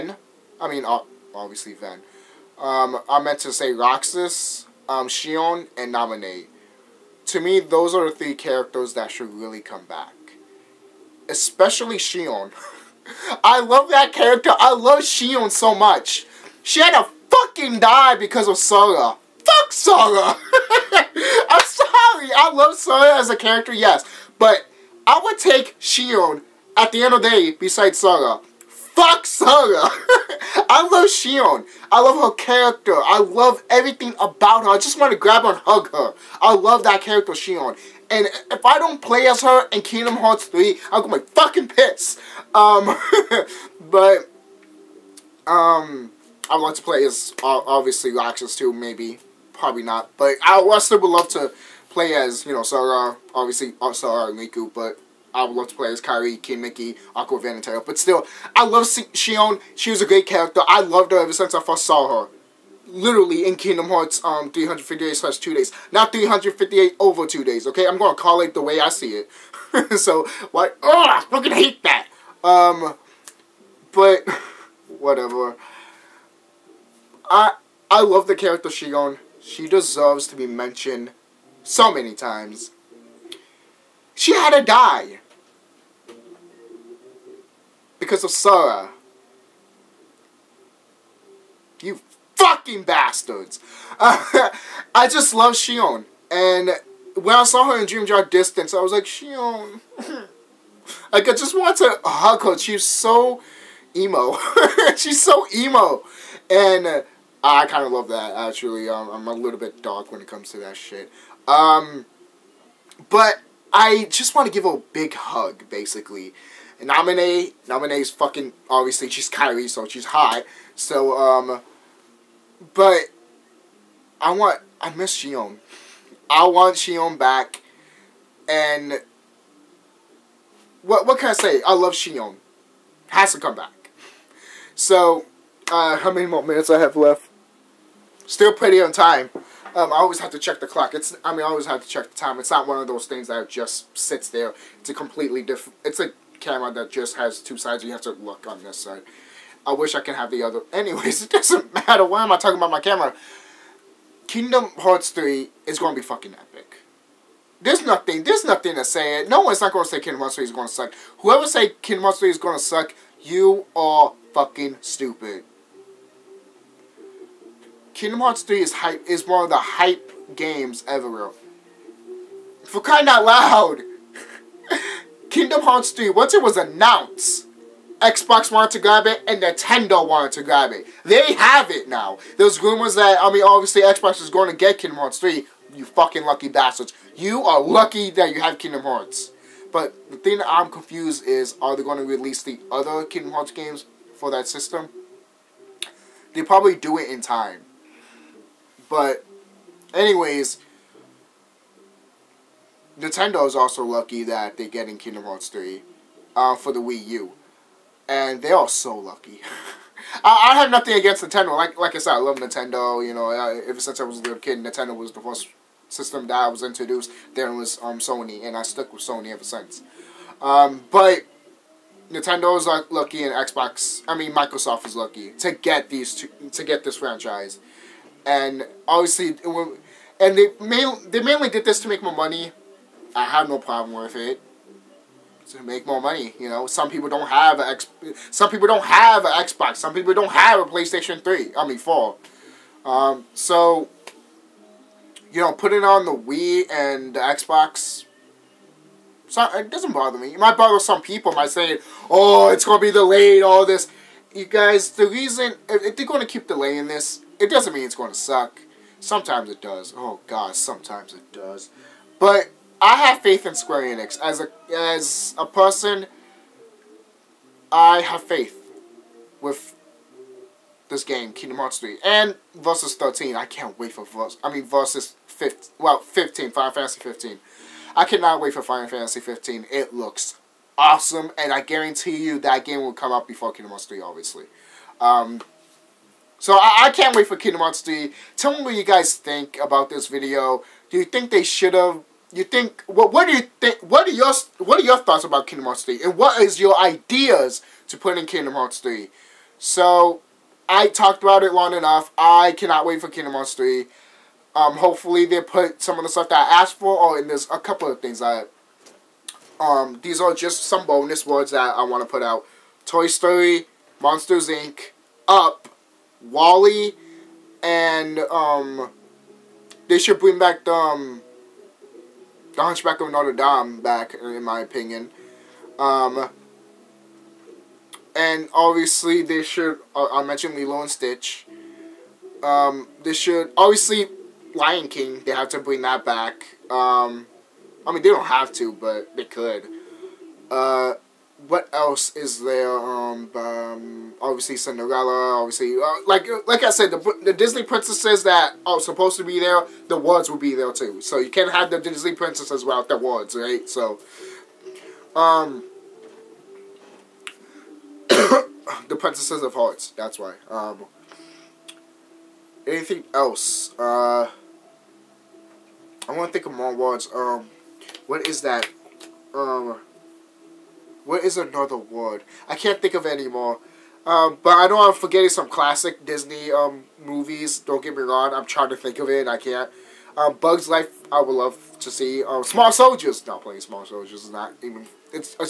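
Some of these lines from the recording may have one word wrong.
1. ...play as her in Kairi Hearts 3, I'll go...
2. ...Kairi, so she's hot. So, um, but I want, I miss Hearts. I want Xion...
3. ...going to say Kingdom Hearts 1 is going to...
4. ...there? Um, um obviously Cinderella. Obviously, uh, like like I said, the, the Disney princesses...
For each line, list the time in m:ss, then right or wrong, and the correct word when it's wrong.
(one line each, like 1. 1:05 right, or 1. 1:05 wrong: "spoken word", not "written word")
1. 0:39 wrong: "Kingdom", not "Kairi"
2. 1:59 wrong: "Xion", not "Hearts"
3. 2:39 wrong: "3", not "1"
4. 5:42 right.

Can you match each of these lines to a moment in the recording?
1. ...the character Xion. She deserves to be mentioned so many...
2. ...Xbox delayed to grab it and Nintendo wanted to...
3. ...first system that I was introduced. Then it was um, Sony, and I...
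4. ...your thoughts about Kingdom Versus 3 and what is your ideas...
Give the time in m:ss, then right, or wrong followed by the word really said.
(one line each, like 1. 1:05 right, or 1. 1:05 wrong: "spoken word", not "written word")
1. 1:18 right
2. 2:58 wrong: "wanted", not "delayed"
3. 3:35 right
4. 4:54 wrong: "Hearts", not "Versus".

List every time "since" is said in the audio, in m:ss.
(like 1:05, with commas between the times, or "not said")
1:01, 3:33, 3:39.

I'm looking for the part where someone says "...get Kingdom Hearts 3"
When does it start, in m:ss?
3:04.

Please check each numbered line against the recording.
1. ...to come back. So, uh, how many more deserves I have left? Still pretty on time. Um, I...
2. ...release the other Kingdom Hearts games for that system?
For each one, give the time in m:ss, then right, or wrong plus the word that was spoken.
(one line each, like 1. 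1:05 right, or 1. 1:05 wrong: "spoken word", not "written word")
1. 2:13 wrong: "minutes", not "deserves"
2. 3:12 right.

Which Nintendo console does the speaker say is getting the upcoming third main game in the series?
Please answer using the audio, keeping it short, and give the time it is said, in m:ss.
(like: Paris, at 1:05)
Wii U, at 3:26.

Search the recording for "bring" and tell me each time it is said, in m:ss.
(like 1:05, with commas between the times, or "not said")
5:20, 5:35.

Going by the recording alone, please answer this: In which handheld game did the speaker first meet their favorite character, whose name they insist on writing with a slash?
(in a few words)
358/2 Days.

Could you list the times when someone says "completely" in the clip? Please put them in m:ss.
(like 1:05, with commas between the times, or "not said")
2:24.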